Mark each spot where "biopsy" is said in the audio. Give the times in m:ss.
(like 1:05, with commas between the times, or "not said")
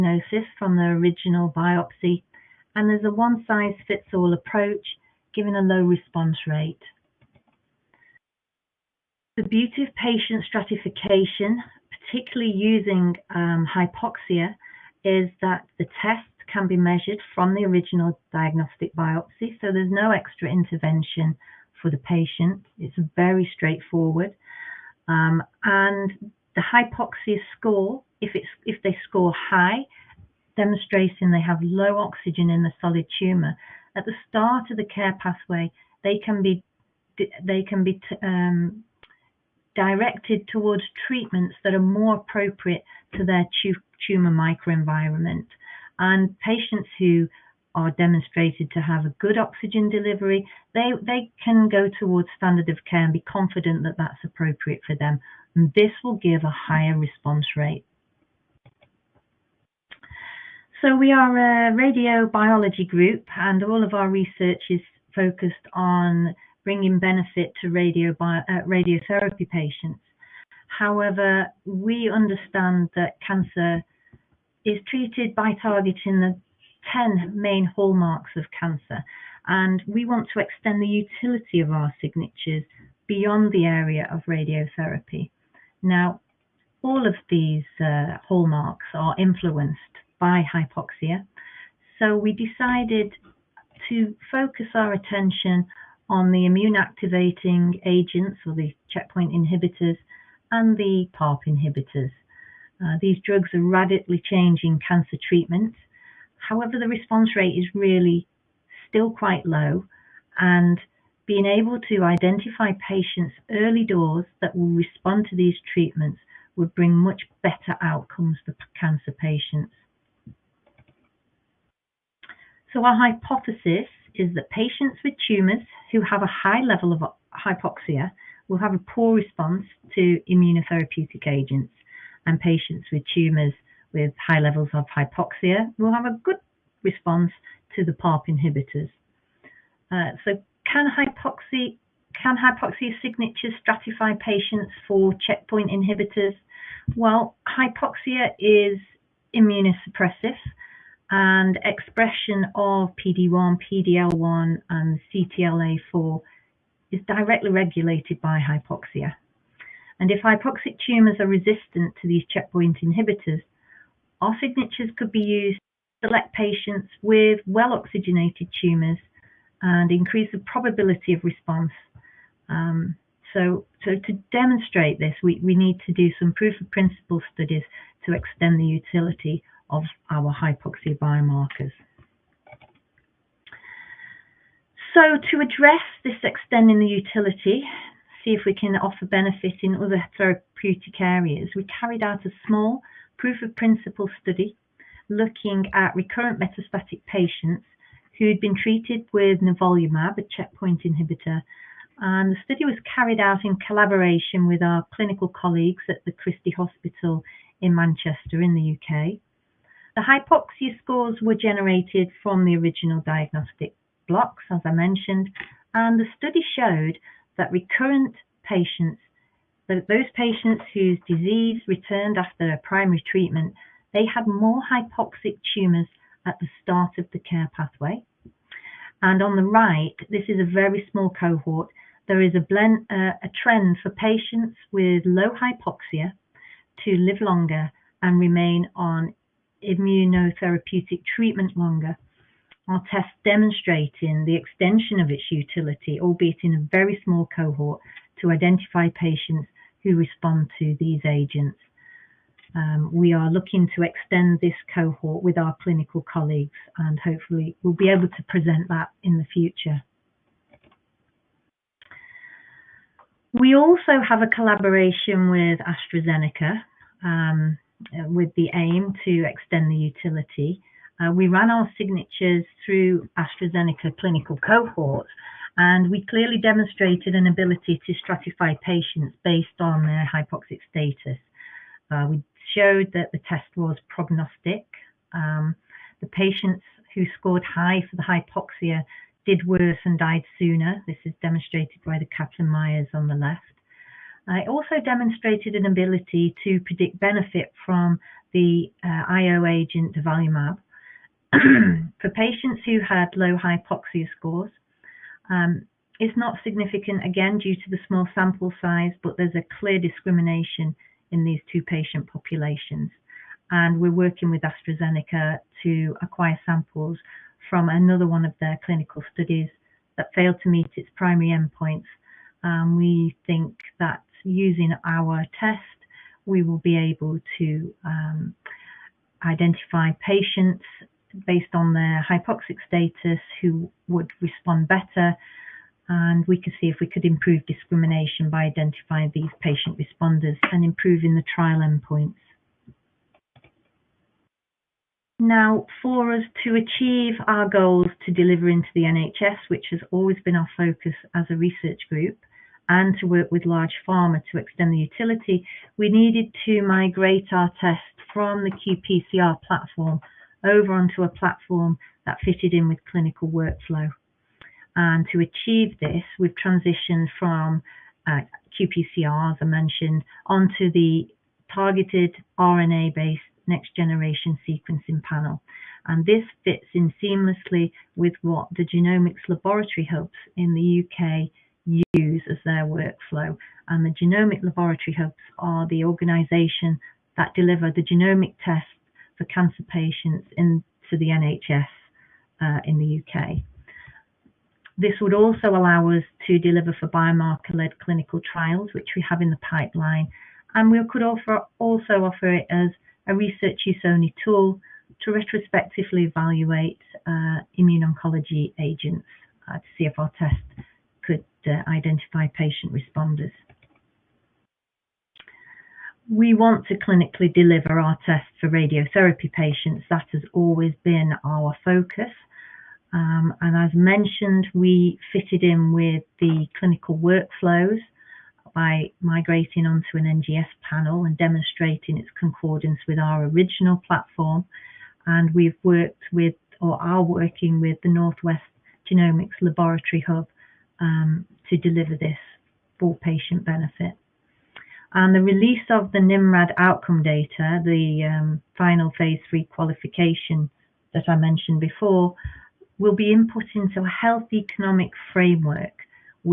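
0:01, 0:18.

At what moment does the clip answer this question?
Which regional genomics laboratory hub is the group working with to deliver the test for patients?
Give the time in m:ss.
7:17.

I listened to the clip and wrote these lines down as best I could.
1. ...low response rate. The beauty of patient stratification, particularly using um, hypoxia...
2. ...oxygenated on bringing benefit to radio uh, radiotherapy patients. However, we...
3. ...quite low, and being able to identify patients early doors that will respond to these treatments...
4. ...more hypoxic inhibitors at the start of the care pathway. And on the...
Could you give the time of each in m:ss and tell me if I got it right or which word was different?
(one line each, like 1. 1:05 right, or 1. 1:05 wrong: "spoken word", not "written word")
1. 0:05 right
2. 1:05 wrong: "focused", not "oxygenated"
3. 1:49 right
4. 3:44 wrong: "tumours", not "inhibitors".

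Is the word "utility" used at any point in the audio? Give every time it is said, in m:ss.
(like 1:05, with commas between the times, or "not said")
1:21, 2:58, 3:06, 4:05, 4:29, 5:54.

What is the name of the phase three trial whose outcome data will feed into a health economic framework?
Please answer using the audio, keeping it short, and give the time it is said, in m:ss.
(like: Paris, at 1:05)
NIMRAD, at 7:25.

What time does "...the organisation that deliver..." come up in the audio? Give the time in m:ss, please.
6:25.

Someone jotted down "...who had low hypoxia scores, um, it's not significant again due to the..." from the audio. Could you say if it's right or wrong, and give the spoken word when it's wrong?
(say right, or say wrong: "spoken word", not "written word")
right.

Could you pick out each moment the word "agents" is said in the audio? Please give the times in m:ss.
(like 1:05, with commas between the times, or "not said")
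1:37, 2:11, 4:11, 4:59, 6:48.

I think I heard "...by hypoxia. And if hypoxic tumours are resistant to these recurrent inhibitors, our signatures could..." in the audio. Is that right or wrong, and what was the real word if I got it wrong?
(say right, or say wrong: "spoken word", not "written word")
wrong: "checkpoint", not "recurrent".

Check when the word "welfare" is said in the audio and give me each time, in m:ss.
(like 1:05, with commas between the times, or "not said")
not said.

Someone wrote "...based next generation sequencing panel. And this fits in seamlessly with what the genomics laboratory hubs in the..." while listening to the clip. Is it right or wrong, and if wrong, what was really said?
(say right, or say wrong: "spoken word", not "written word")
right.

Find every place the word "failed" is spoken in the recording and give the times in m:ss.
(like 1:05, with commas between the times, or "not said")
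5:20.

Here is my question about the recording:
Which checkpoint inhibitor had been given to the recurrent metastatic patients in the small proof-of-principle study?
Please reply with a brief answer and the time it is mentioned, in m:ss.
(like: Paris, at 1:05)
nivolumab, at 3:19.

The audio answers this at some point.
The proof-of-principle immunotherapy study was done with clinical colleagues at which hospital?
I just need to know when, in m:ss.
3:26.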